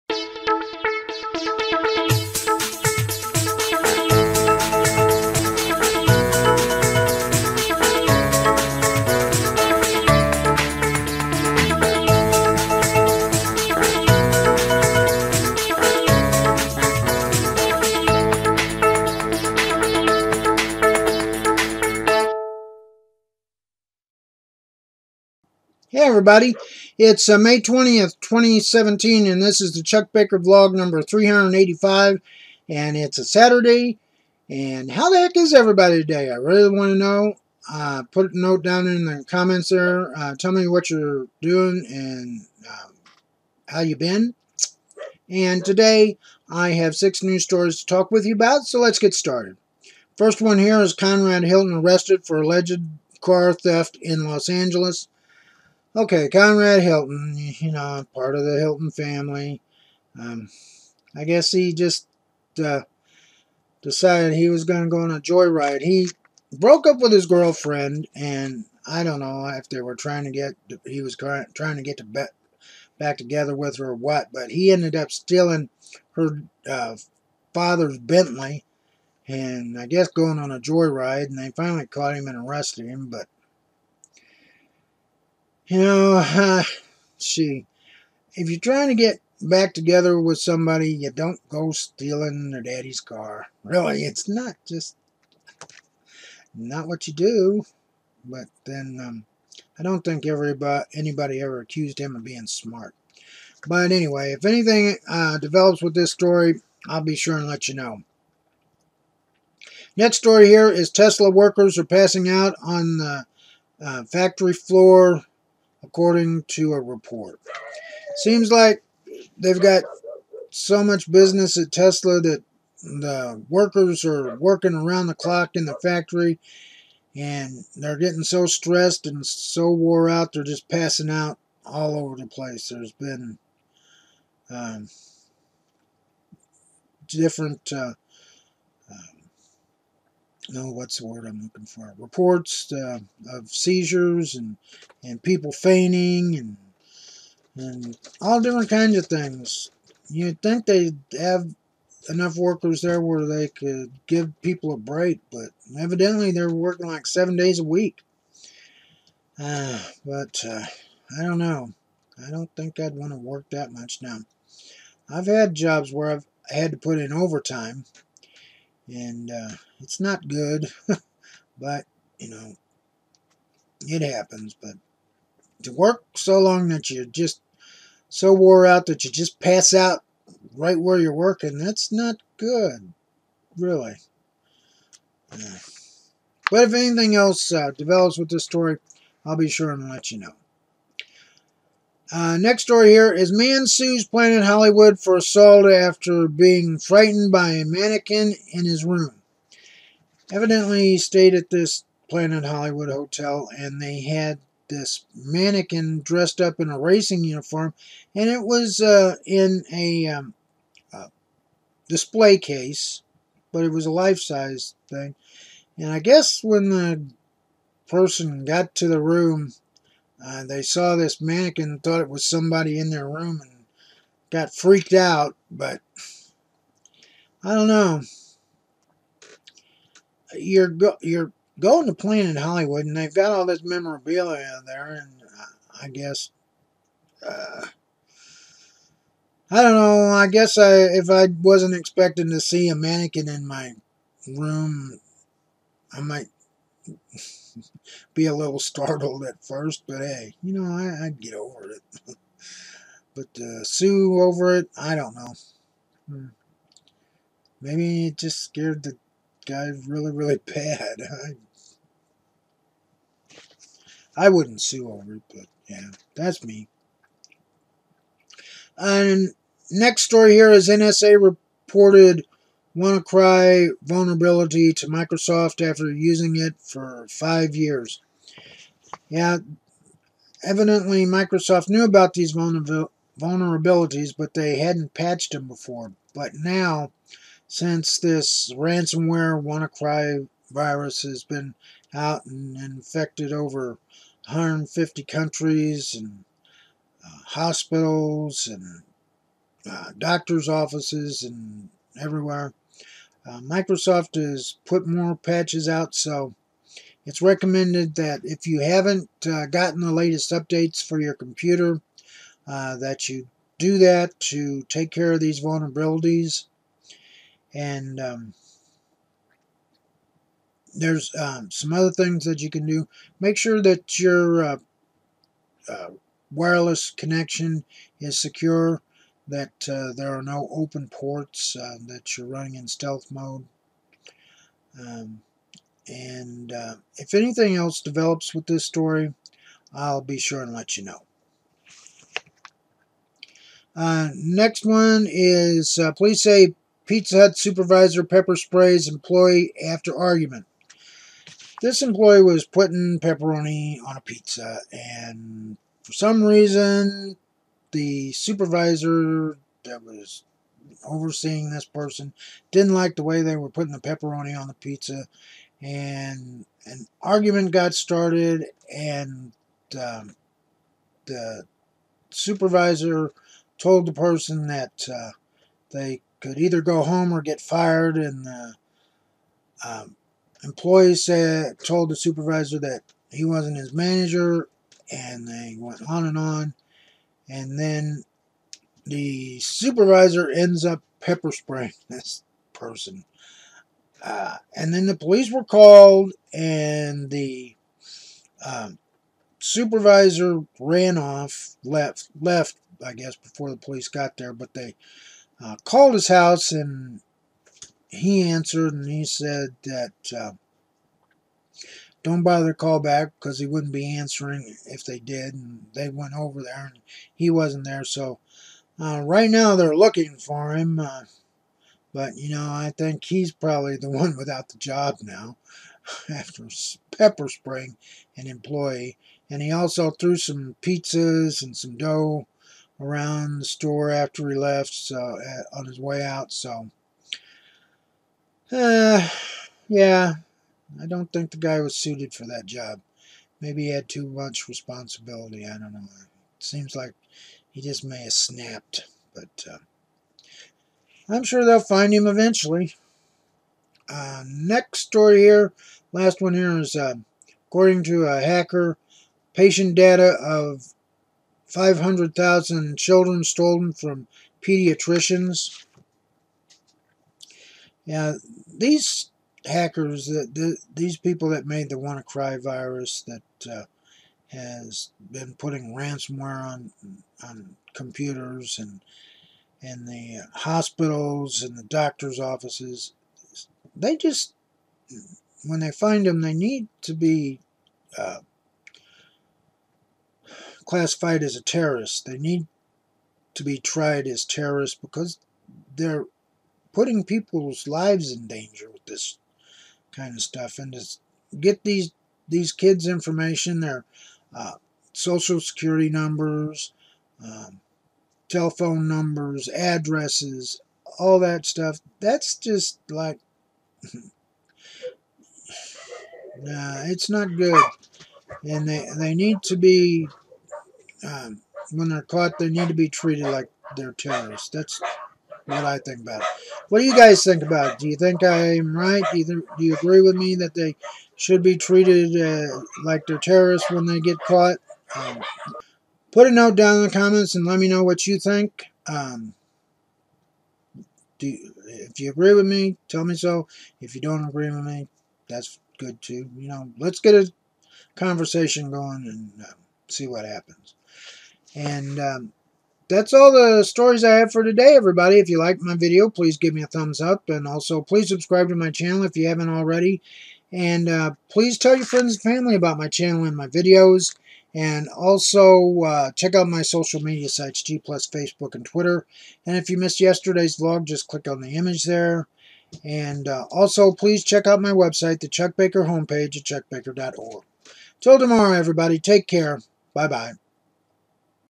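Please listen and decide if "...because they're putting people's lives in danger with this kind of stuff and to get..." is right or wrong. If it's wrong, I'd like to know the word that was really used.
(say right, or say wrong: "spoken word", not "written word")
right.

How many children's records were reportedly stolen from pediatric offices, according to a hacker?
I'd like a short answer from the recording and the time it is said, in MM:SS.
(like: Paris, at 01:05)
500,000, at 07:41.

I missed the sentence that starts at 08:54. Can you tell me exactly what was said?
Um, put a note down in the comments and let me know what you think.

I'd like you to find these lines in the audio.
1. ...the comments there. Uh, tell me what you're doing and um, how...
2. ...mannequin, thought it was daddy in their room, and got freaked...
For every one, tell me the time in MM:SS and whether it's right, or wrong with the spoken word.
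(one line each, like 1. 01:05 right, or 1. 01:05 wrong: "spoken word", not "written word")
1. 00:39 right
2. 03:41 wrong: "somebody", not "daddy".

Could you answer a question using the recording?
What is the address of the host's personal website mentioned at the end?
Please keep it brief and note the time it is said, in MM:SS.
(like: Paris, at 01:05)
chuckbaker.org, at 09:36.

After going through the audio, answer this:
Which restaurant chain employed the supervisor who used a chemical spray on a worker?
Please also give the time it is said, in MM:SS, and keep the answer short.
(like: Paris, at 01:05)
Pizza Hut, at 05:46.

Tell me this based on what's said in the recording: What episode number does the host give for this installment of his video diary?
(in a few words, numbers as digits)
385.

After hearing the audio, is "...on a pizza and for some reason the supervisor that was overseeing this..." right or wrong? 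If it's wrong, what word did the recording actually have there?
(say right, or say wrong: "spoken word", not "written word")
right.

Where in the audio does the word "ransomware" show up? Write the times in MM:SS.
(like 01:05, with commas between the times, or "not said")
04:48, 07:55.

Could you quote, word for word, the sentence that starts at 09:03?
If you don't agree with me, that's good too.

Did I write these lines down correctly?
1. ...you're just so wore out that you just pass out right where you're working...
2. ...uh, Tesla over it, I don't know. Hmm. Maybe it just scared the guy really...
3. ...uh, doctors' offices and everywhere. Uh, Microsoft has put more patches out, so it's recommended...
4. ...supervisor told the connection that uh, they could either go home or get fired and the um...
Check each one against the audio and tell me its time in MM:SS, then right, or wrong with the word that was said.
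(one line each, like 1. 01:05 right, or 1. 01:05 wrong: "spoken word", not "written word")
1. 02:56 right
2. 04:13 wrong: "Sue", not "Tesla"
3. 04:59 right
4. 06:12 wrong: "person", not "connection".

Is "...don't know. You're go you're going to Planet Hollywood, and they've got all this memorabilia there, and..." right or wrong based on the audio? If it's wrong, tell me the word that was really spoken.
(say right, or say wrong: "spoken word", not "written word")
right.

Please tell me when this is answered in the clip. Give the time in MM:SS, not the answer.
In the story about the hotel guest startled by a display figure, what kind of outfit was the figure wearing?
03:26.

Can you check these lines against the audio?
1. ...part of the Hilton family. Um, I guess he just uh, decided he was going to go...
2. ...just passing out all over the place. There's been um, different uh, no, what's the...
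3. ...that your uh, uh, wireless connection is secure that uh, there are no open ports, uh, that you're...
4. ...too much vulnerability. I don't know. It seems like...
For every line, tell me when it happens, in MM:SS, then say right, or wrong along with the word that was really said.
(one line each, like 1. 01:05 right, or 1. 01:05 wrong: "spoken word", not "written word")
1. 00:58 right
2. 02:10 right
3. 05:23 right
4. 07:23 wrong: "responsibility", not "vulnerability".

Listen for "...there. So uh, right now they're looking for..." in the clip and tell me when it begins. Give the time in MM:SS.
06:57.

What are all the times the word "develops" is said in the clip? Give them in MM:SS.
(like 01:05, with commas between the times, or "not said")
01:45, 03:07, 05:37.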